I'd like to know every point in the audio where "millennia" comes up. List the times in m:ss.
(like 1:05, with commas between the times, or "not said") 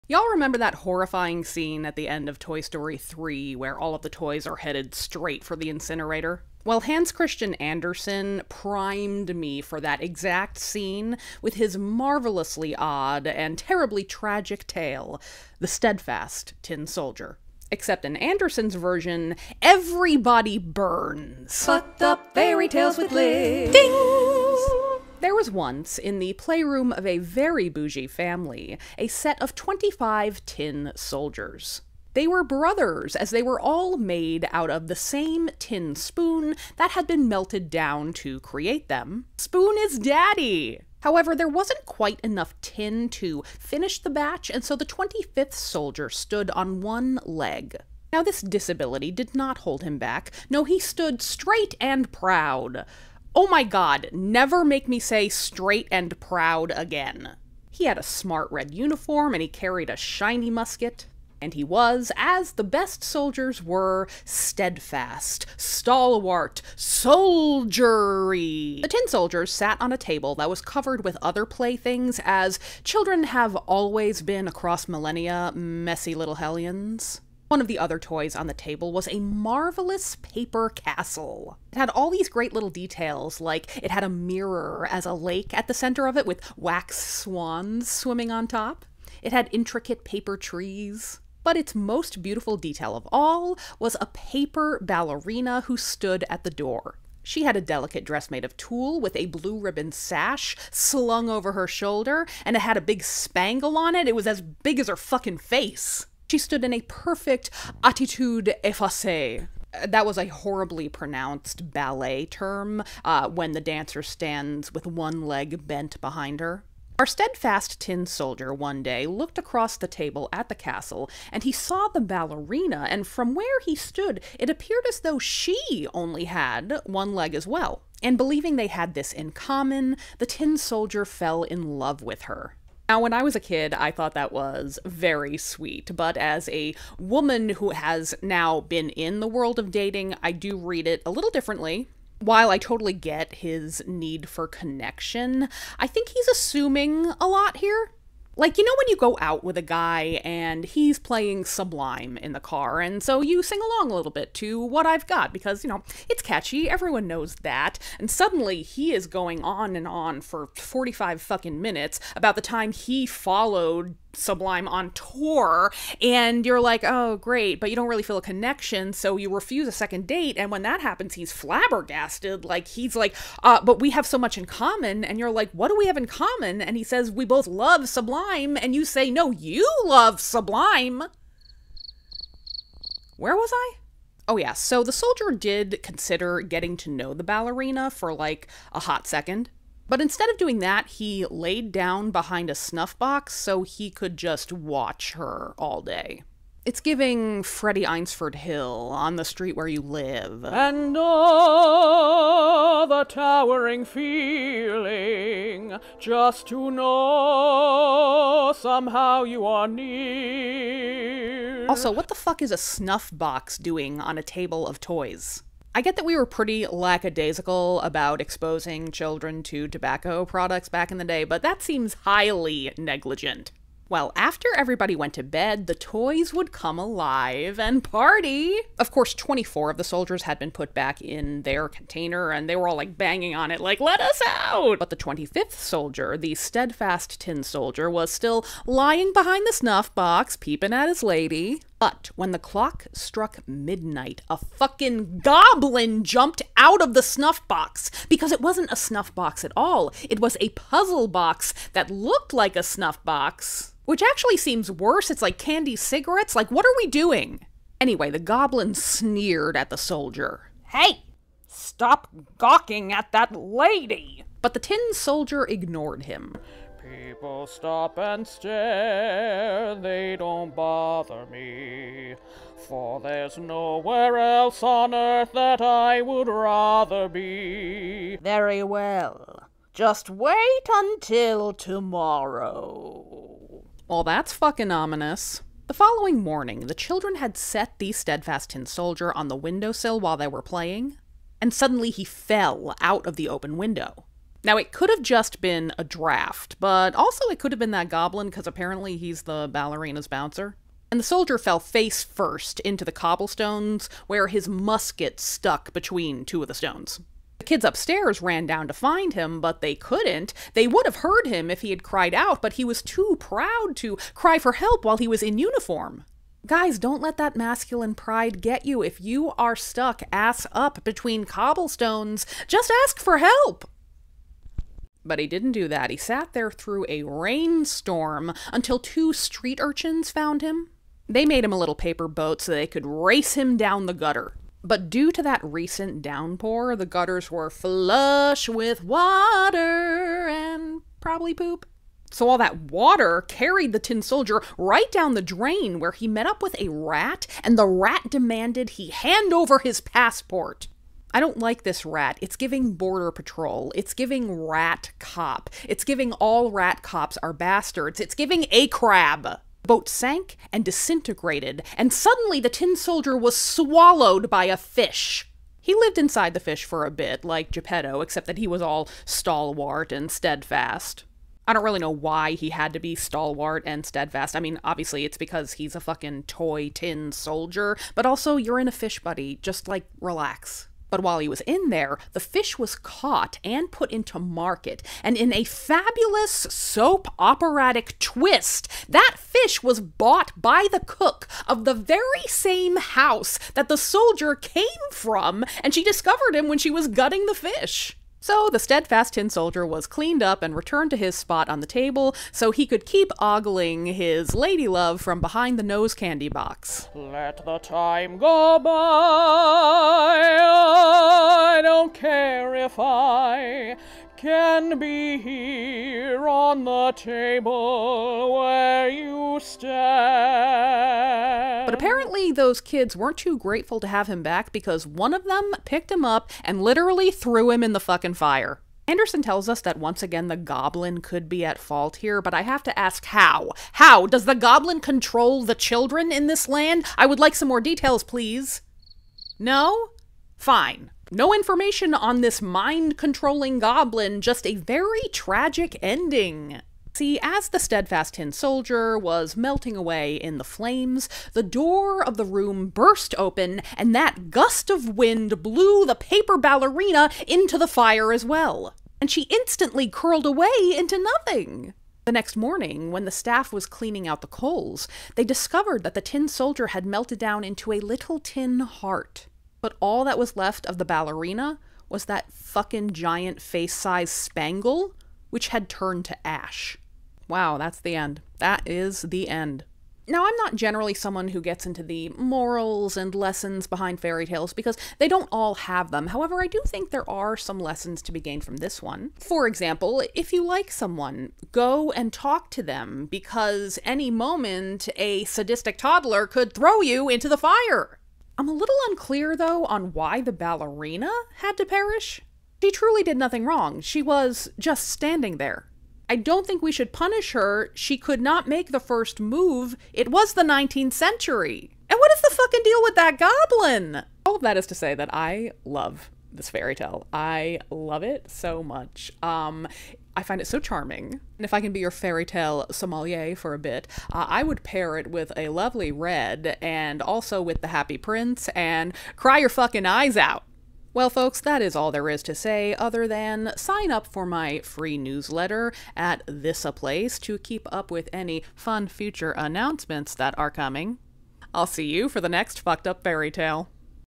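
1:14.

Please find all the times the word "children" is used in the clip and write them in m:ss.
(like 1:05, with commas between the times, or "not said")
1:12, 3:38, 4:46, 7:15.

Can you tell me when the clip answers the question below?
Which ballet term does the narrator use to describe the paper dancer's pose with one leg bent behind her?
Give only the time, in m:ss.
1:47.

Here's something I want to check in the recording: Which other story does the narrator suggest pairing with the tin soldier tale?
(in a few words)
The Happy Prince.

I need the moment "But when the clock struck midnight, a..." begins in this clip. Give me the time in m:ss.
4:01.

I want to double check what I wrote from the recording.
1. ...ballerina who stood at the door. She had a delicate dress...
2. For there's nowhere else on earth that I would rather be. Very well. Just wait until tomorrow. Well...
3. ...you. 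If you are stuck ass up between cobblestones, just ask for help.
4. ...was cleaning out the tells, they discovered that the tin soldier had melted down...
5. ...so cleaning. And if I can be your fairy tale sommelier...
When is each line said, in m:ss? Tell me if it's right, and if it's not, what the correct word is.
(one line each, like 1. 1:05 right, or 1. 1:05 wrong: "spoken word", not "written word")
1. 1:34 right
2. 4:32 right
3. 5:18 right
4. 7:43 wrong: "coals", not "tells"
5. 8:40 wrong: "charming", not "cleaning".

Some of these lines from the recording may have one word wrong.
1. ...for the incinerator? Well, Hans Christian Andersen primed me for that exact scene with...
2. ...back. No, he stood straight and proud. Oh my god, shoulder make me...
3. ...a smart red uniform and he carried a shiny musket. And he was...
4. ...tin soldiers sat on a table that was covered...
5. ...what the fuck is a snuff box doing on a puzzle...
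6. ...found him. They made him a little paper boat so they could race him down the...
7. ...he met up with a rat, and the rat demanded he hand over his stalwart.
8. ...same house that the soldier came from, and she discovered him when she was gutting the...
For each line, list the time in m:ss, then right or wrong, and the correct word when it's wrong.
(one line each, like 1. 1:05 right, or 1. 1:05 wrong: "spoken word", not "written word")
1. 0:05 right
2. 0:49 wrong: "never", not "shoulder"
3. 0:57 right
4. 1:08 right
5. 3:31 wrong: "table", not "puzzle"
6. 5:30 right
7. 5:45 wrong: "passport", not "stalwart"
8. 6:32 right.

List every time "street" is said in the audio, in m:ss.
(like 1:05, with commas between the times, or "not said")
3:19, 5:29.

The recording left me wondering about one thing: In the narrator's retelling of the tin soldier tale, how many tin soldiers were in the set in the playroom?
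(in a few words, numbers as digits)
25.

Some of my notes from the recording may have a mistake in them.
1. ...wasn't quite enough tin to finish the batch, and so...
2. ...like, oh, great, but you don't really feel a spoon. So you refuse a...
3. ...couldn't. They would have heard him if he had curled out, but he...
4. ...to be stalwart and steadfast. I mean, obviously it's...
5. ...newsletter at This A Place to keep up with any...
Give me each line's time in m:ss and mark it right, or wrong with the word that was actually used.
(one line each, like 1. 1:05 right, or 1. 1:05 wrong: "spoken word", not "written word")
1. 0:41 right
2. 2:46 wrong: "connection", not "spoon"
3. 5:09 wrong: "cried", not "curled"
4. 6:12 right
5. 8:54 right.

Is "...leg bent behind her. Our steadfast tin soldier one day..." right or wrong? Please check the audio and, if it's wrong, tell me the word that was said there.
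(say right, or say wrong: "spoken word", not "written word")
right.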